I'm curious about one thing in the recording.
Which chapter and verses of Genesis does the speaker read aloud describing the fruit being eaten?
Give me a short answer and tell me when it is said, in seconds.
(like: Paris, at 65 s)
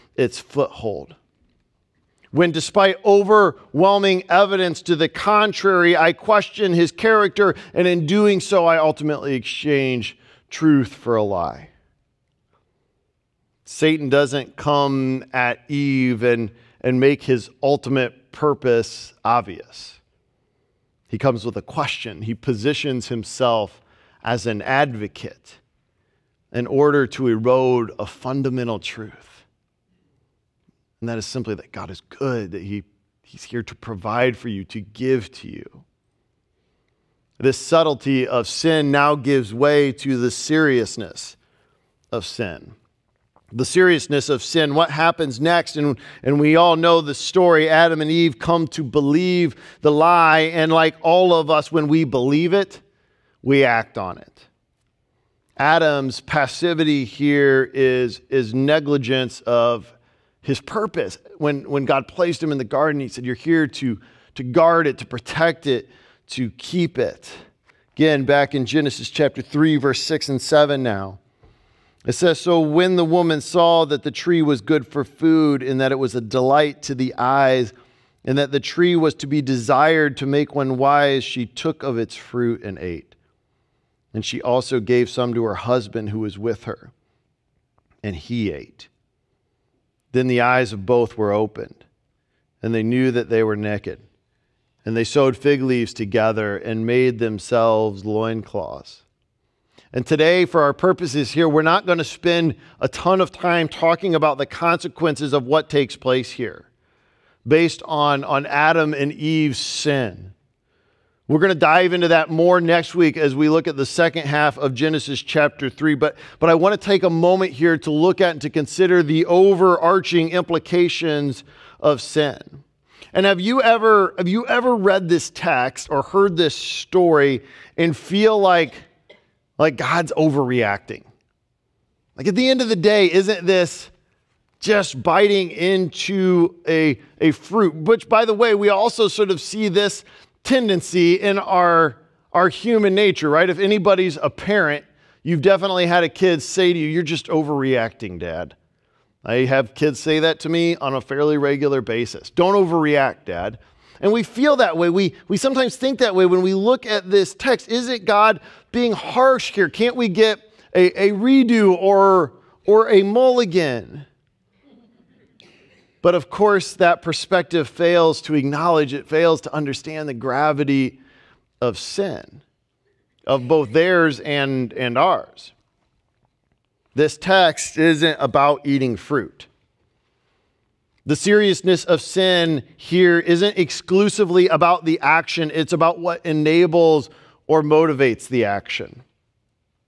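Genesis 3:6-7, at 68 s.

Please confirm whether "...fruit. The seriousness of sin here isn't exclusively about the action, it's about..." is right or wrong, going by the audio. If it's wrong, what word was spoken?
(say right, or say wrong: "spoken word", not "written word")
right.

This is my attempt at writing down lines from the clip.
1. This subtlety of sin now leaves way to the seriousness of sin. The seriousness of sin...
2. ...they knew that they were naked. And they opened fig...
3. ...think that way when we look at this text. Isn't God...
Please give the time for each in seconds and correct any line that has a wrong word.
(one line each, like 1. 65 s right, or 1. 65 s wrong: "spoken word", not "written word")
1. 37 s wrong: "gives", not "leaves"
2. 92 s wrong: "sewed", not "opened"
3. 155 s right.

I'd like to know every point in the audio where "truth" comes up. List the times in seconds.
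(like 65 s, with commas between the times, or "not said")
10 s, 28 s.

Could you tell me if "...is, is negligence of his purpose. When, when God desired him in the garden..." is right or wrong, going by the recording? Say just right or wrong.
wrong.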